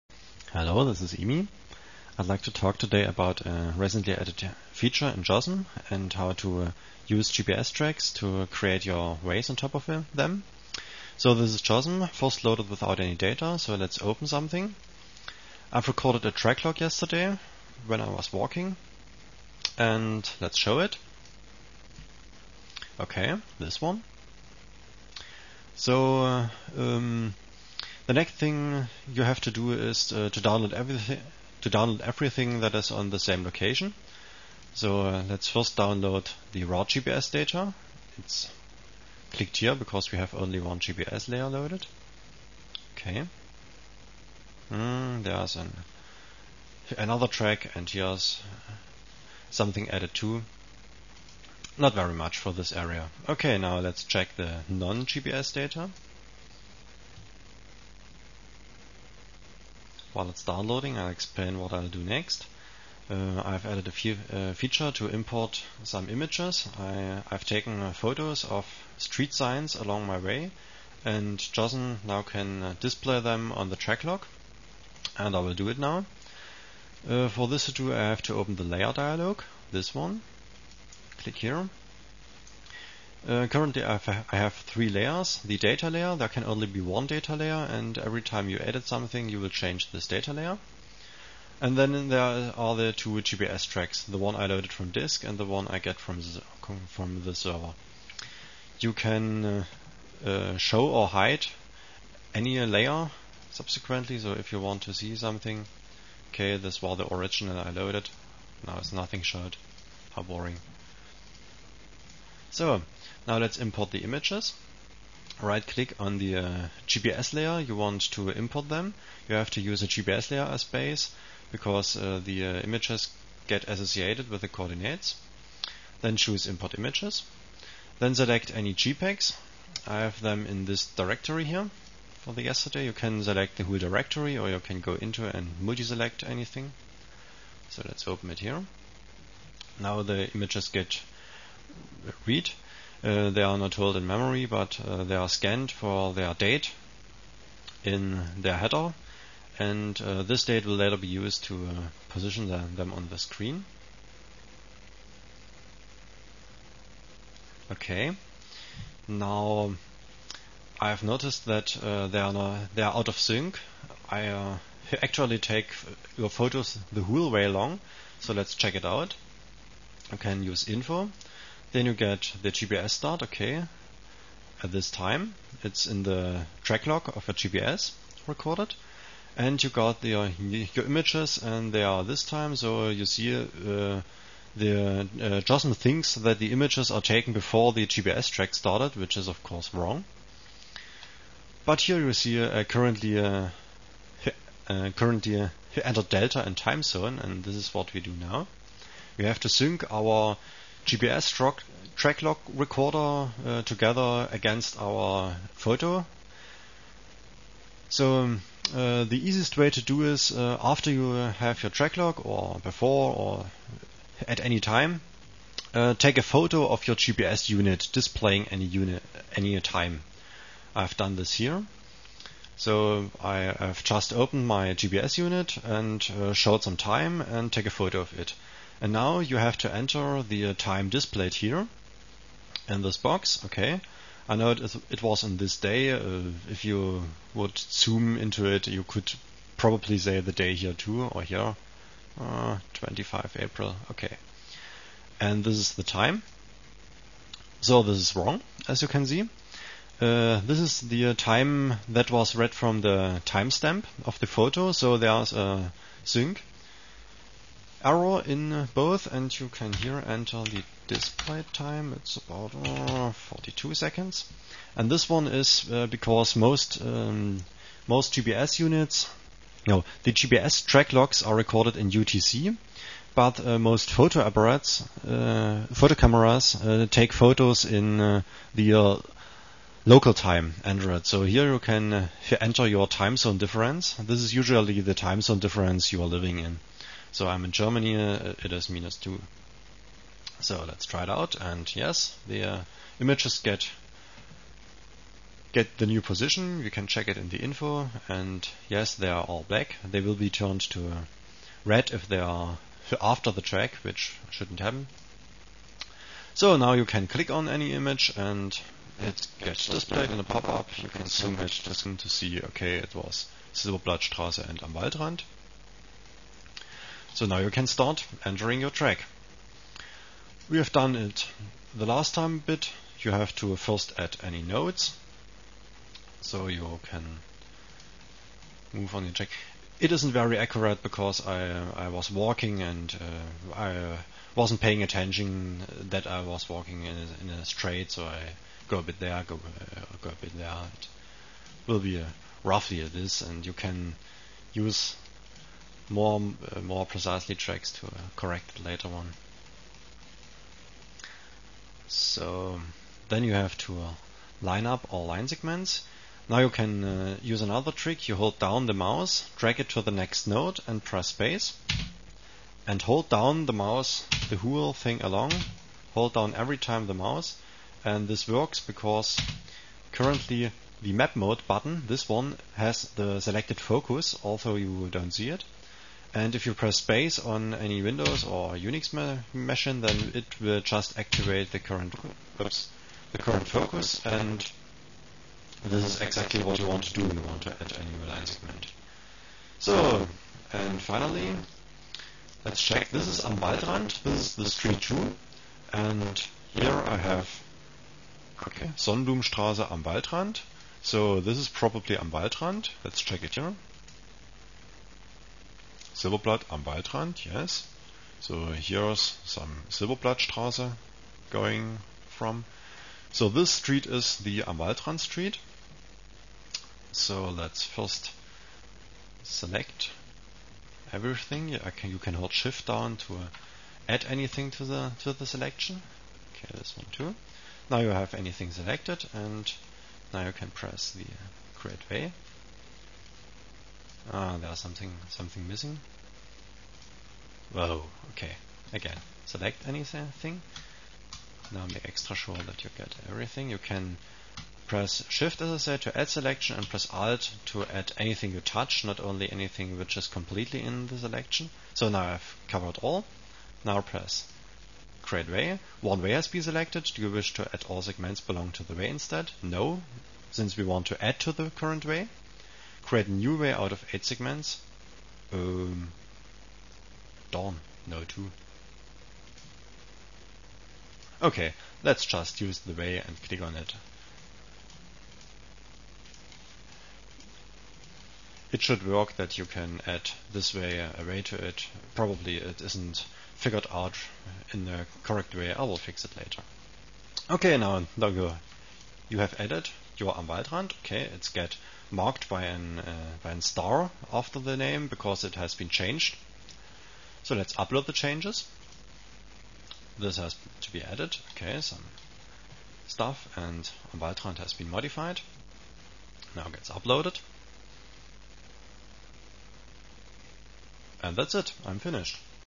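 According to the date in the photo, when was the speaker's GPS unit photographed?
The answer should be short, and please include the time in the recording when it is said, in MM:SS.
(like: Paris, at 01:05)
25 April, at 04:02.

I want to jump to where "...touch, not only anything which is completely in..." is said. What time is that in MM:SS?
07:28.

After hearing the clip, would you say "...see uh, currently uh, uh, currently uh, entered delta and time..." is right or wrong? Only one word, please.
right.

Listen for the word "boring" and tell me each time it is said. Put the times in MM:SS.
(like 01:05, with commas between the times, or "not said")
01:50.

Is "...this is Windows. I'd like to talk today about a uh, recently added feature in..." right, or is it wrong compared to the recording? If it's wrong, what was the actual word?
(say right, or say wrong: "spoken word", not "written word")
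wrong: "Imi", not "Windows".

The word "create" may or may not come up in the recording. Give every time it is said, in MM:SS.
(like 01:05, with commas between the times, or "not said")
00:08, 07:11, 07:35, 07:42.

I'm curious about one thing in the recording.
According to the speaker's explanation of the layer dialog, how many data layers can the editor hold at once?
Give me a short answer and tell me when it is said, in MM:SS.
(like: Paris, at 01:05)
1, at 01:26.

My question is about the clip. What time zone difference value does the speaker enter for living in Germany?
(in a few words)
-2.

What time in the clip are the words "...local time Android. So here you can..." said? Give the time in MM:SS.
04:39.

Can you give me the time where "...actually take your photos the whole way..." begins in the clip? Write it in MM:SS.
02:45.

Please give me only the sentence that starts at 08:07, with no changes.
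Okay, now, now you, you have added your am Waldrand.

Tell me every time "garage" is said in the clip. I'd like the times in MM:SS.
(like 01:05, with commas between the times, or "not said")
not said.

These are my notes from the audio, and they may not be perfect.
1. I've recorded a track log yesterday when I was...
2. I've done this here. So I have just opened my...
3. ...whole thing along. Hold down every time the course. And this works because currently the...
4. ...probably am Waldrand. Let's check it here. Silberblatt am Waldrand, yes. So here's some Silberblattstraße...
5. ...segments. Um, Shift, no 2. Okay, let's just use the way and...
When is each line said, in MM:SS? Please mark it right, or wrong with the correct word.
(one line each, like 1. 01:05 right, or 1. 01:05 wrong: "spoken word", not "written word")
1. 00:15 right
2. 03:40 right
3. 06:04 wrong: "mouse", not "course"
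4. 06:41 right
5. 07:44 wrong: "Dawn", not "Shift".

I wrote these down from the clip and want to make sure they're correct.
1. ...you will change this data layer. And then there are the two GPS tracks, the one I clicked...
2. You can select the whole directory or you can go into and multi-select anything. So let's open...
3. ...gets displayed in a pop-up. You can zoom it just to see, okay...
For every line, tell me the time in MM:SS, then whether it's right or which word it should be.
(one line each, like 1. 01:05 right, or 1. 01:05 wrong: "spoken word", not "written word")
1. 01:29 wrong: "loaded", not "clicked"
2. 02:12 right
3. 05:09 right.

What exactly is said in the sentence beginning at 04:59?
They will be turned to uh, red if they are after the track, which shouldn't happen.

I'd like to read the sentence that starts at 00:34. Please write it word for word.
So uh, let's first download the raw GPS data.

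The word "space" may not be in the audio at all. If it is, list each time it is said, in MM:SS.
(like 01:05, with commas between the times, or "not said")
06:01, 06:16.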